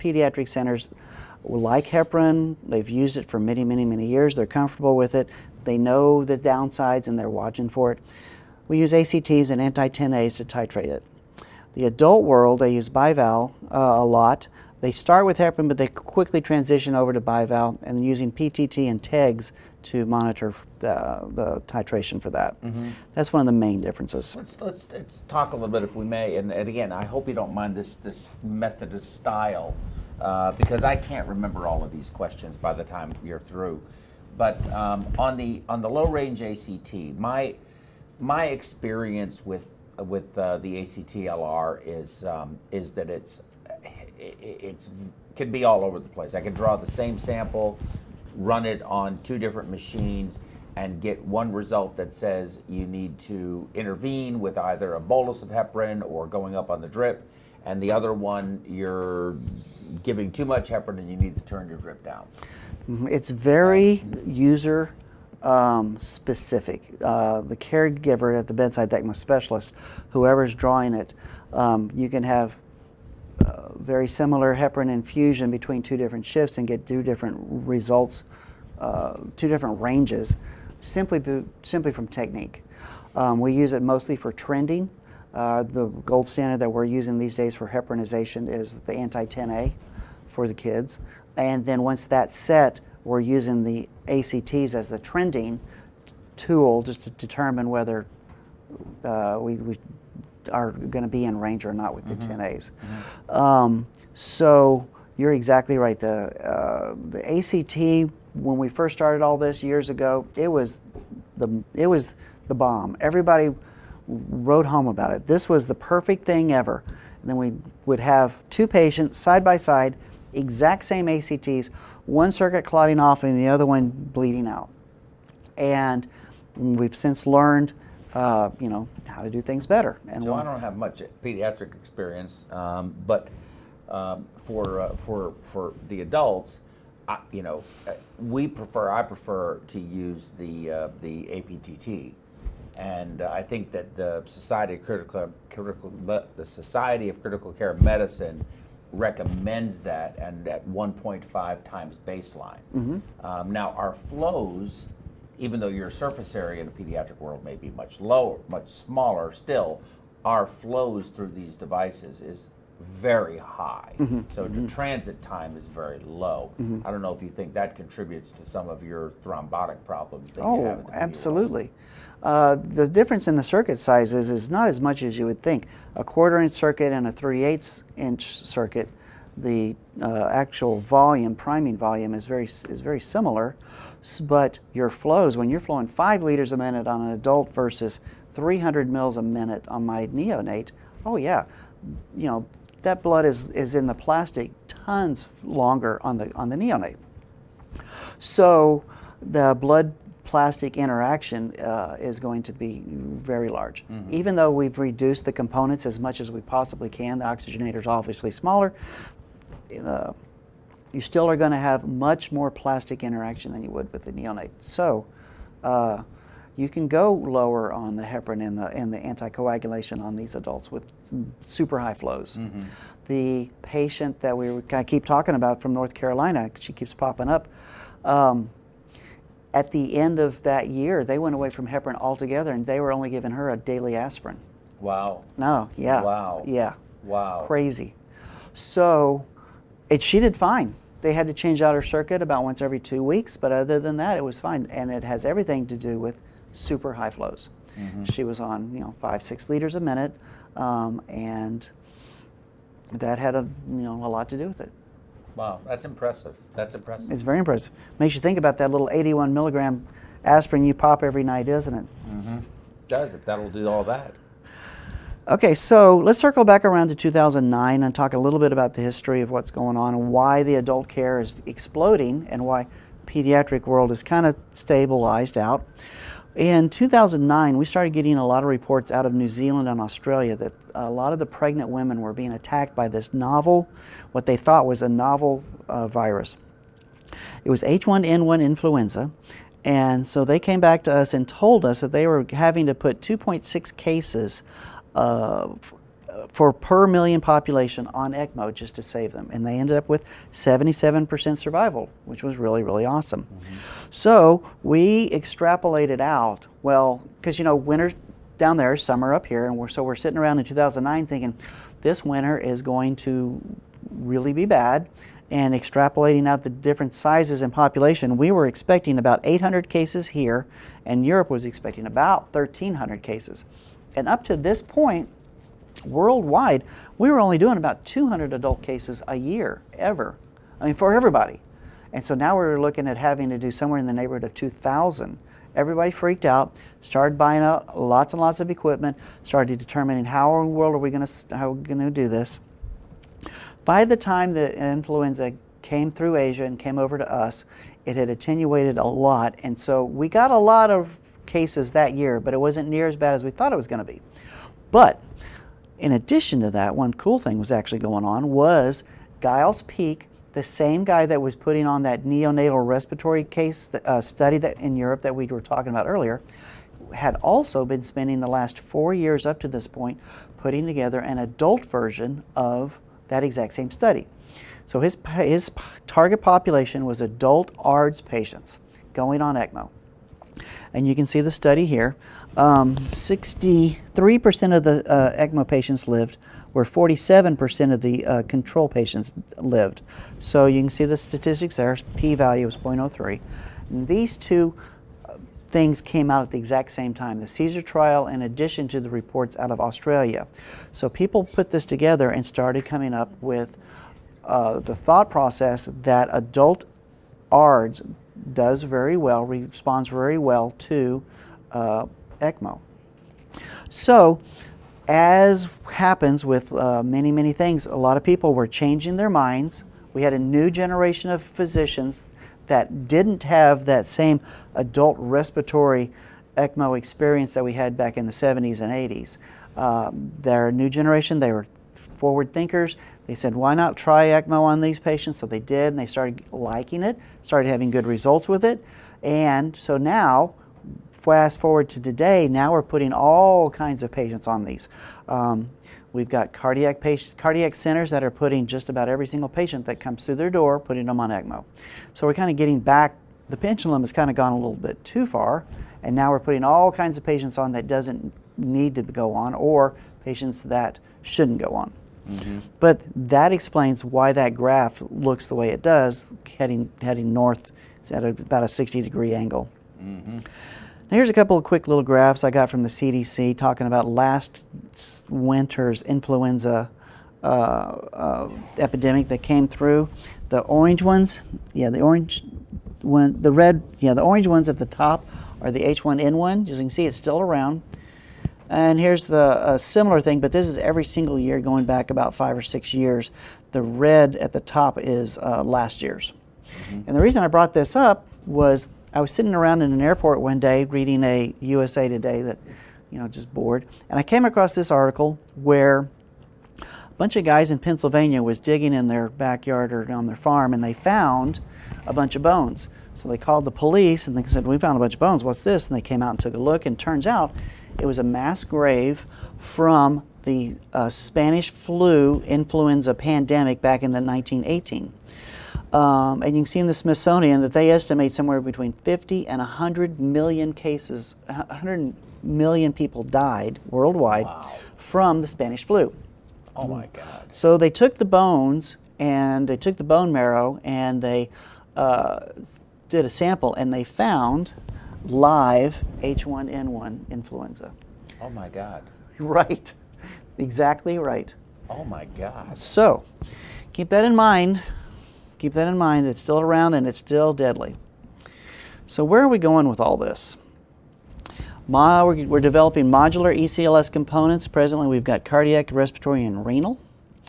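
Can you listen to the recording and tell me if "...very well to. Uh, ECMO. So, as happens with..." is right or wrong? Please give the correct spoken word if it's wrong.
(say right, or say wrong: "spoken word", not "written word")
right.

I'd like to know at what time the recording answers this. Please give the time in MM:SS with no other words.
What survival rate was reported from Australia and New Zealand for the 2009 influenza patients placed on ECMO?
05:00.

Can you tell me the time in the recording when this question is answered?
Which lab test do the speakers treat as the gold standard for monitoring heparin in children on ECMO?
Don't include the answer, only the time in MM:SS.
01:28.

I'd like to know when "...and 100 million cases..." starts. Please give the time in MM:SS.
08:49.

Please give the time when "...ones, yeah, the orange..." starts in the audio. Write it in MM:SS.
08:00.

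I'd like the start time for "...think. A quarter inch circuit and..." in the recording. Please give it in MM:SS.
02:55.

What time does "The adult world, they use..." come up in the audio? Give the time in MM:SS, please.
00:11.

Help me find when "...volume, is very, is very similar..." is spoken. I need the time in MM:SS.
03:01.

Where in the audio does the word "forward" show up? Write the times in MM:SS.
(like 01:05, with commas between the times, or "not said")
07:11, 07:21.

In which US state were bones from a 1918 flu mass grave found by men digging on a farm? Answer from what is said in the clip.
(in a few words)
Pennsylvania.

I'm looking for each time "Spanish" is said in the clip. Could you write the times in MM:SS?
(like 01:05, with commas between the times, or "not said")
08:40, 08:55.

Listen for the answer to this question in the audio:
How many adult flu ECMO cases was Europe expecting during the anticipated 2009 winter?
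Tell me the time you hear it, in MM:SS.
05:22.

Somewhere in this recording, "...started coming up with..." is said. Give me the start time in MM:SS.
06:42.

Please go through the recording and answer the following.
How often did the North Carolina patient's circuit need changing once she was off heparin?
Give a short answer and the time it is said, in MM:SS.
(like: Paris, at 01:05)
every two weeks, at 04:02.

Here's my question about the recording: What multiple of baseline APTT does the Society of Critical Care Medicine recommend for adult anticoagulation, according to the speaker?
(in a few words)
1.5 times.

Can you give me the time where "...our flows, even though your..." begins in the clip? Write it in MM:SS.
02:33.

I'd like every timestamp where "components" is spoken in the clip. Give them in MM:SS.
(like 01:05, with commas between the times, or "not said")
03:25, 09:23.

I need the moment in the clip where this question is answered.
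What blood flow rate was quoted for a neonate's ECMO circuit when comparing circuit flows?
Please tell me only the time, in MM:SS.
03:08.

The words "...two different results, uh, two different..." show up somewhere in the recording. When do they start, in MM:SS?
01:16.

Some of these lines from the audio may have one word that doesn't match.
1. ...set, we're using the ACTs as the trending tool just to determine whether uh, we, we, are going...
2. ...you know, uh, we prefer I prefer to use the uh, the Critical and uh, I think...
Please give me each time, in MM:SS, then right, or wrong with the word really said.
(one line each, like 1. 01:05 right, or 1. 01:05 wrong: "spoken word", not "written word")
1. 01:32 right
2. 02:17 wrong: "APTT", not "Critical".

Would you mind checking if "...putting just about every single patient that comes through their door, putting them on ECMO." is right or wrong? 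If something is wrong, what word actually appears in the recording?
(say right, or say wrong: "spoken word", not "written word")
right.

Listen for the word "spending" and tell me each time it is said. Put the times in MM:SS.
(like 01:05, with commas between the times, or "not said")
06:07.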